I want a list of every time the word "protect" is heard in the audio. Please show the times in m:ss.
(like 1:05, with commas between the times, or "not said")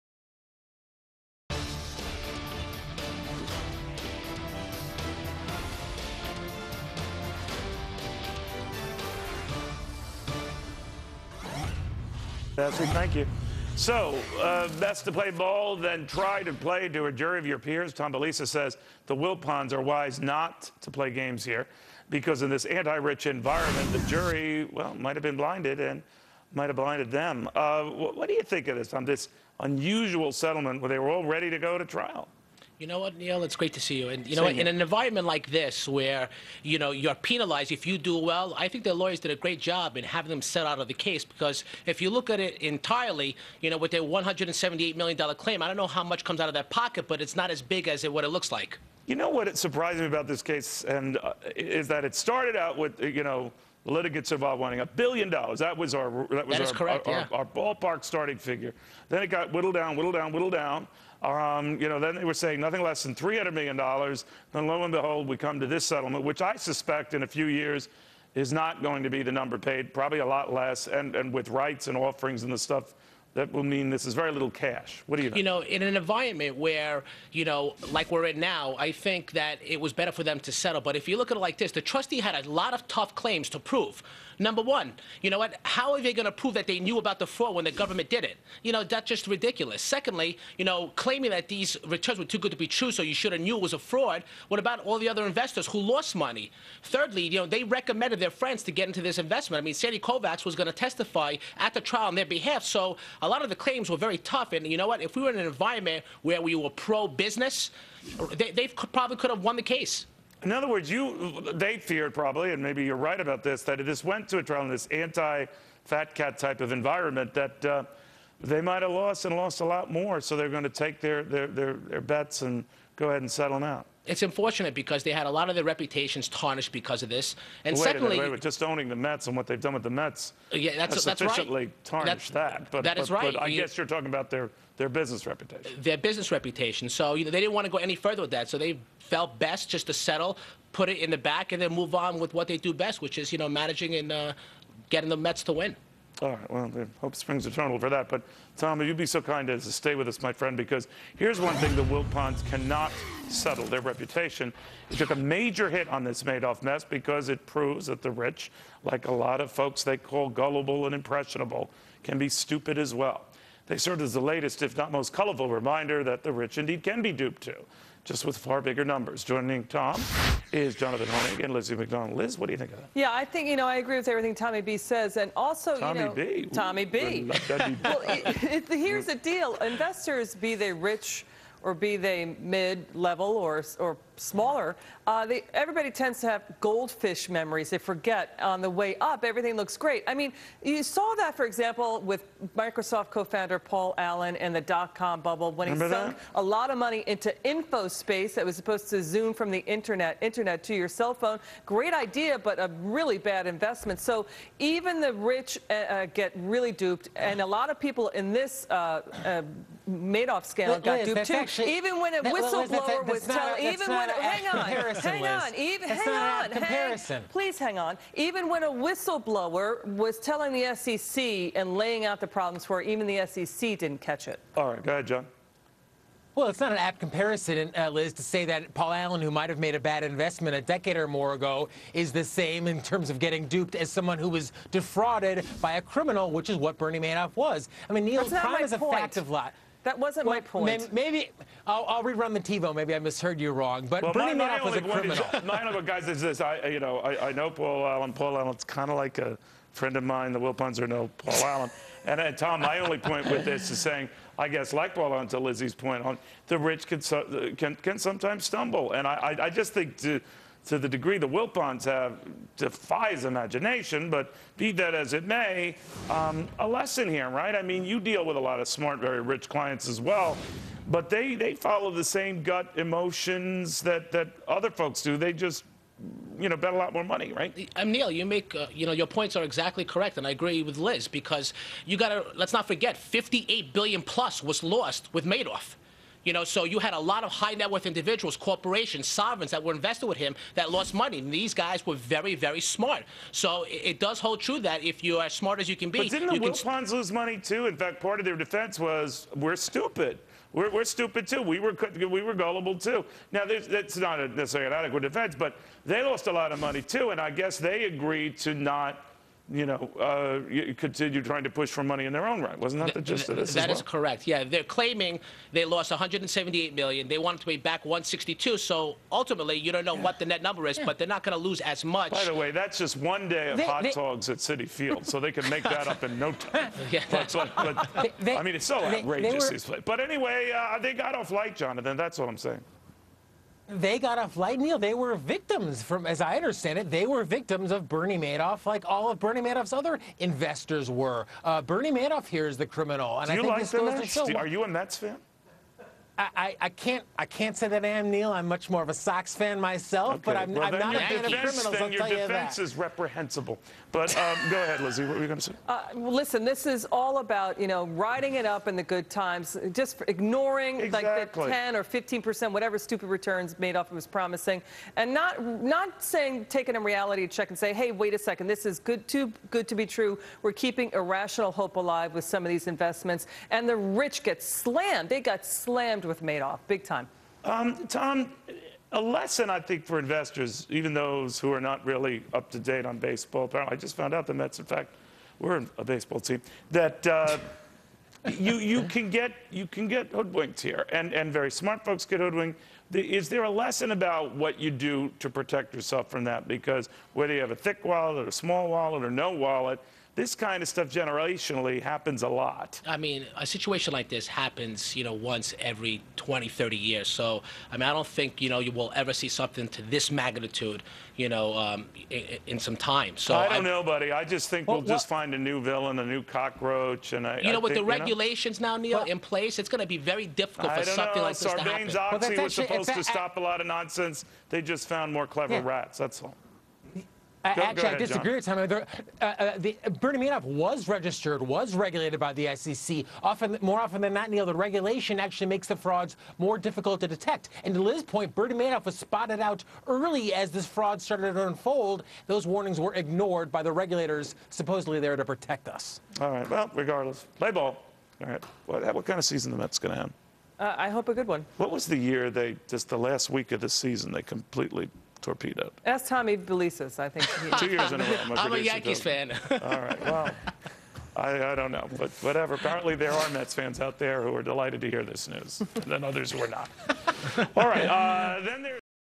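6:35, 7:25.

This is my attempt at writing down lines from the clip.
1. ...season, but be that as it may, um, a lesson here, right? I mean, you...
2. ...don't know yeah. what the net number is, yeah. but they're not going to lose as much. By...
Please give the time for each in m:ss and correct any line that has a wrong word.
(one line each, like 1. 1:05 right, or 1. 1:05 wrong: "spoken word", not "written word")
1. 4:23 wrong: "imagination", not "season"
2. 5:19 right.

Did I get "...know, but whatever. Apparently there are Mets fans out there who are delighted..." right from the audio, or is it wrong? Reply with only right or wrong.
right.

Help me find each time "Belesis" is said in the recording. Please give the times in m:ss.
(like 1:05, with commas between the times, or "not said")
0:18, 7:36.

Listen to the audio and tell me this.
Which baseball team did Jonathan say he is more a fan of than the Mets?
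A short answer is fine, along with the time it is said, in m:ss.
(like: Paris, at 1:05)
Sox, at 5:48.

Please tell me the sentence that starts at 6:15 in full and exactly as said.
They got slammed scammed with Madoff, big time.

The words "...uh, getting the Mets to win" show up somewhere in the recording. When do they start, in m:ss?
2:24.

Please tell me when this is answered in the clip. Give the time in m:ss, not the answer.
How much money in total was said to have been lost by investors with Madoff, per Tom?
4:42.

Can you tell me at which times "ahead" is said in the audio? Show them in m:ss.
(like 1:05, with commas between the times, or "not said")
2:03, 3:44, 5:54, 7:07.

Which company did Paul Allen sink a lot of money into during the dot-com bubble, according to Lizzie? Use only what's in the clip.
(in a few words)
InfoSpace.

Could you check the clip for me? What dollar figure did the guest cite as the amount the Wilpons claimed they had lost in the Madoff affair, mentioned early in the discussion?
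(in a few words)
$178 million.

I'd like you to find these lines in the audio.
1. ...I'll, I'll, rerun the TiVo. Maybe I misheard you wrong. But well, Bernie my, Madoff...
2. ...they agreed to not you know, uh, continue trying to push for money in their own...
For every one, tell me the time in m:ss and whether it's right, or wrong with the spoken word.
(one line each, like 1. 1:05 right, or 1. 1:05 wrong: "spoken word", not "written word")
1. 4:01 right
2. 5:07 right.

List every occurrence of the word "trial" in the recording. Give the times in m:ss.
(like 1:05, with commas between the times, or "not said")
0:31, 1:41, 1:54.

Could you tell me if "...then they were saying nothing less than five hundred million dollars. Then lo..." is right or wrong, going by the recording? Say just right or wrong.
wrong.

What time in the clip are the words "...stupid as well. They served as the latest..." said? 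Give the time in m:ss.
2:42.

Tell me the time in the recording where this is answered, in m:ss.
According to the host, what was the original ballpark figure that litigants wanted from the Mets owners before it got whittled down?
0:54.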